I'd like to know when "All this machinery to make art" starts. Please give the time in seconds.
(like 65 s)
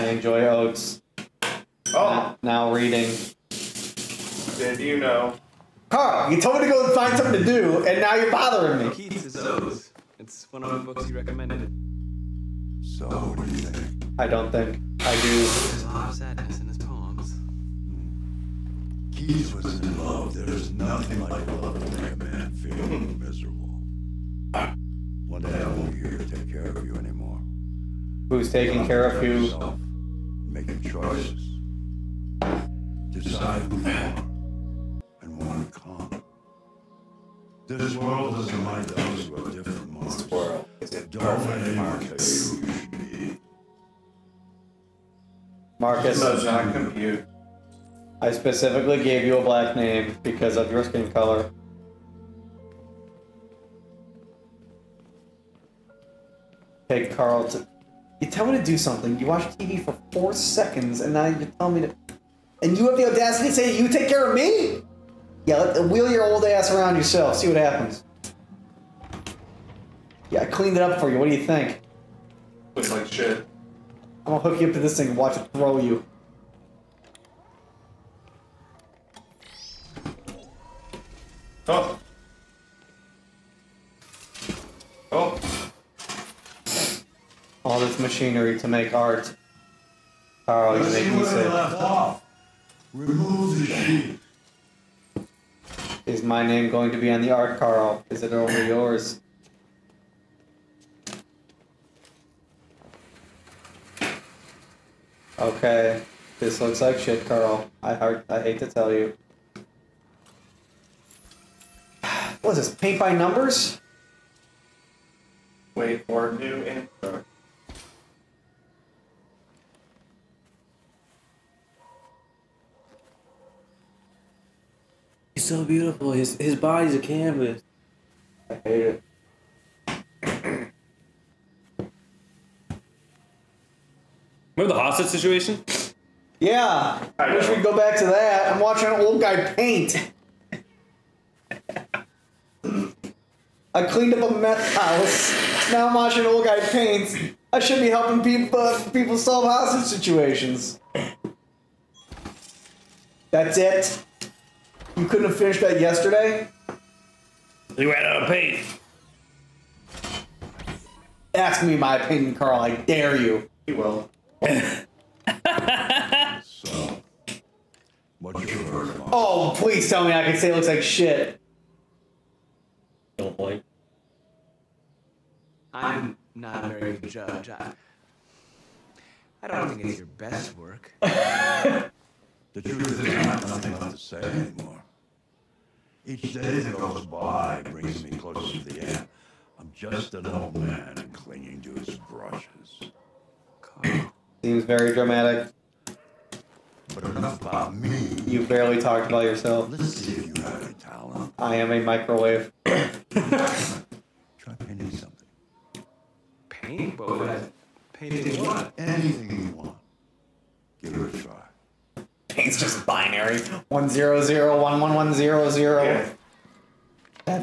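87 s.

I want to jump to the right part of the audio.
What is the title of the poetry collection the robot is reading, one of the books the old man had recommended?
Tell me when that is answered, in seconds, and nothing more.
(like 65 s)
8 s.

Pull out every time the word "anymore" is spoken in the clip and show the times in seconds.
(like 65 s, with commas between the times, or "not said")
26 s, 184 s.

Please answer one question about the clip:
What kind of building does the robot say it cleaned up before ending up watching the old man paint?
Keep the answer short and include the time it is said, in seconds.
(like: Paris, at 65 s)
A meth house, at 144 s.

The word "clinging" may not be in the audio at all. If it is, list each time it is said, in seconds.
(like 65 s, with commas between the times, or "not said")
191 s.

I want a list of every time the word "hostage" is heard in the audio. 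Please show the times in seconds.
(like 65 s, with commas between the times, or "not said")
134 s, 149 s.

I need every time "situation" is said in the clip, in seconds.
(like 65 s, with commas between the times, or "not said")
135 s, 149 s.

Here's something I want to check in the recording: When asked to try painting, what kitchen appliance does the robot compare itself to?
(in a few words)
A microwave.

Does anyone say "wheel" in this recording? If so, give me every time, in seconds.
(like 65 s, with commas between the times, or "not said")
65 s.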